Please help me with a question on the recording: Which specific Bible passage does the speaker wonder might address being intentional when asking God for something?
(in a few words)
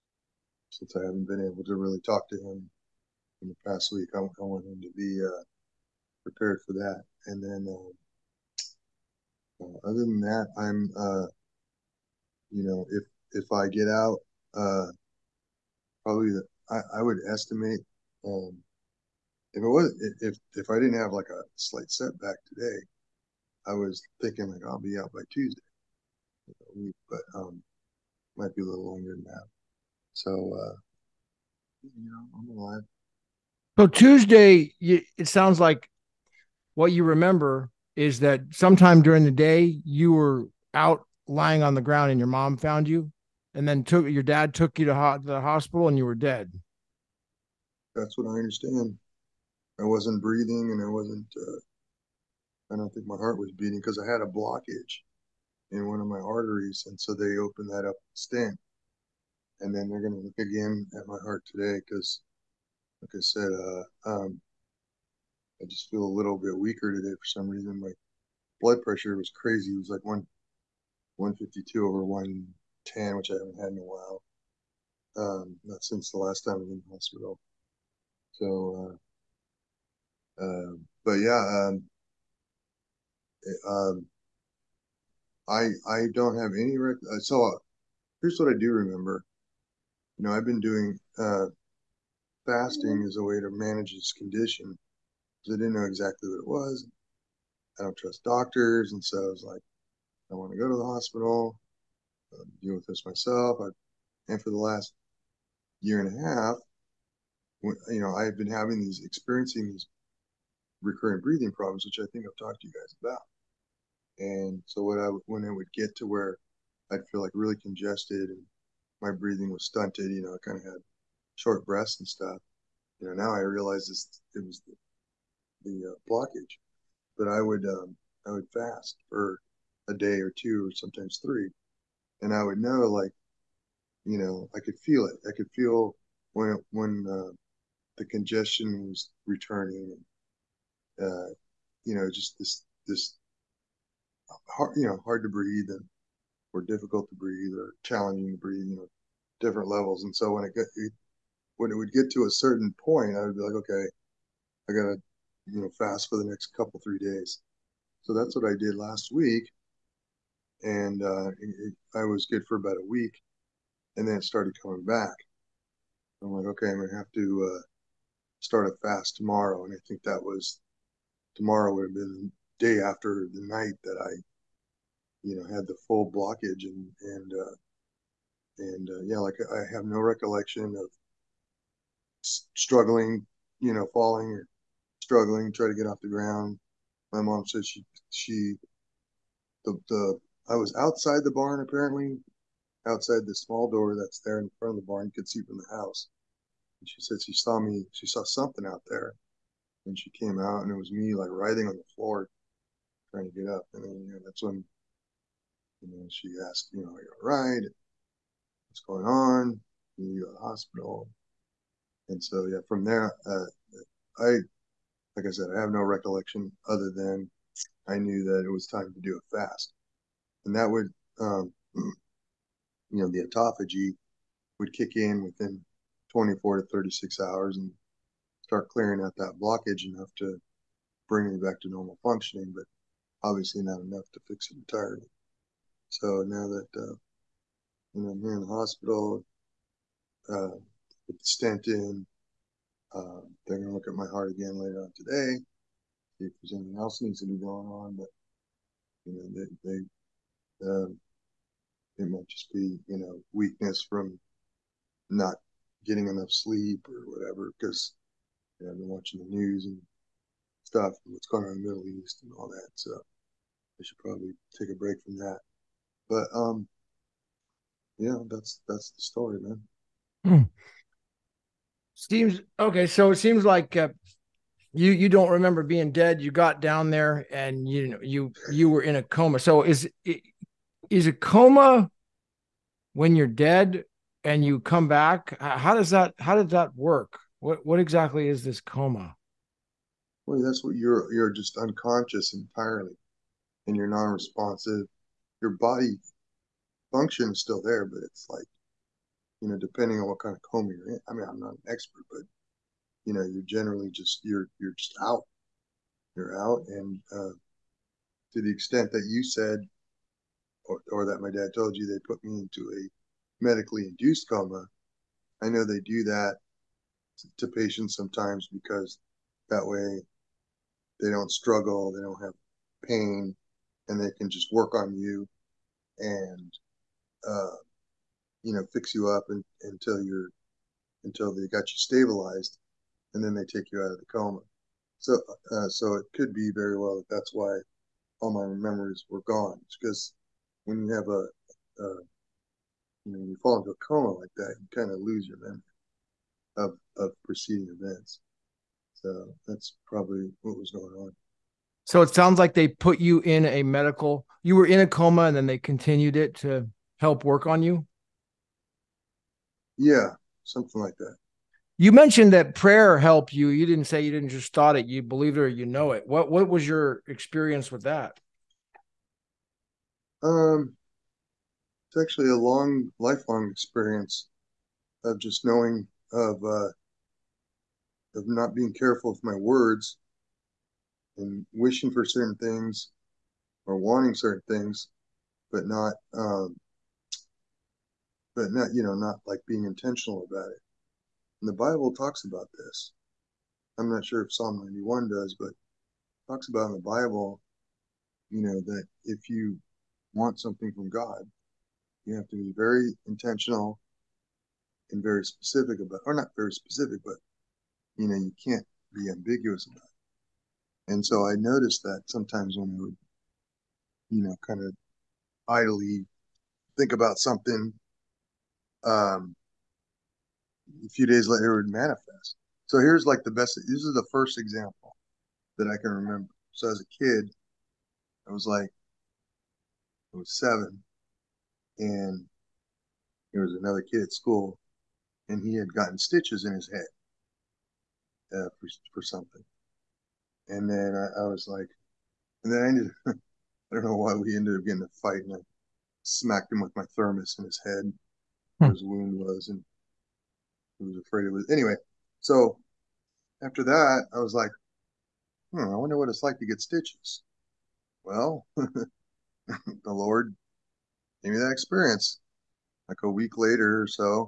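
Psalm 91.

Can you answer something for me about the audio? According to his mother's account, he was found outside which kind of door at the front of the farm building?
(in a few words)
Small door.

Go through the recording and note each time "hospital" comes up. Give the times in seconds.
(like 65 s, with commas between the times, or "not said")
45 s, 76 s, 100 s, 210 s, 238 s.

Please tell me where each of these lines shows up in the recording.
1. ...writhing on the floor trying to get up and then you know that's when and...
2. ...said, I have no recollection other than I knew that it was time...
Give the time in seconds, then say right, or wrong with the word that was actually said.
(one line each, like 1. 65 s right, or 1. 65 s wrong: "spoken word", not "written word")
1. 201 s right
2. 215 s right.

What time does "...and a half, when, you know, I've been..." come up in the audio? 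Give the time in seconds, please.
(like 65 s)
106 s.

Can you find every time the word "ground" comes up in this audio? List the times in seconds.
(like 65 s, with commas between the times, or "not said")
41 s, 186 s.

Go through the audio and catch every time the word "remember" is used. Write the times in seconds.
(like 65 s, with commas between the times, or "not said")
37 s, 88 s, 275 s, 425 s.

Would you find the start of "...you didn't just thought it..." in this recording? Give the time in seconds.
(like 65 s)
364 s.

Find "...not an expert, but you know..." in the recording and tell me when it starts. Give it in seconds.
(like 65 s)
301 s.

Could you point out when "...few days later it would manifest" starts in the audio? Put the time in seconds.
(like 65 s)
420 s.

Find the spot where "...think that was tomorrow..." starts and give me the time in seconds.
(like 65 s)
169 s.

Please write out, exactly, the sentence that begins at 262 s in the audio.
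So I should probably take a break from that.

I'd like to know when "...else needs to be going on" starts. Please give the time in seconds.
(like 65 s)
246 s.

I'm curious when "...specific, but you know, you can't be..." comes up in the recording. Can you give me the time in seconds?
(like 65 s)
406 s.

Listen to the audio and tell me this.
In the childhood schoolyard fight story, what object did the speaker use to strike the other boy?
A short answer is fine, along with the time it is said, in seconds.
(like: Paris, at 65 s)
Thermos, at 446 s.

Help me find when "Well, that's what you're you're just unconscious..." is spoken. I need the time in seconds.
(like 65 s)
290 s.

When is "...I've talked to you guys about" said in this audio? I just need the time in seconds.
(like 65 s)
112 s.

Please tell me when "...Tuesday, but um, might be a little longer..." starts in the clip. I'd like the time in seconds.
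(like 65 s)
25 s.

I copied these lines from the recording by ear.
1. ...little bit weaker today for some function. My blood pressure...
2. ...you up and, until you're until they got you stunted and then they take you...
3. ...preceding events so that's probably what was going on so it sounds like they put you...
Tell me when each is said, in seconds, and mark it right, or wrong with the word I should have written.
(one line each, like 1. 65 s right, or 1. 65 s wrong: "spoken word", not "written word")
1. 66 s wrong: "reason", not "function"
2. 328 s wrong: "stabilized", not "stunted"
3. 347 s right.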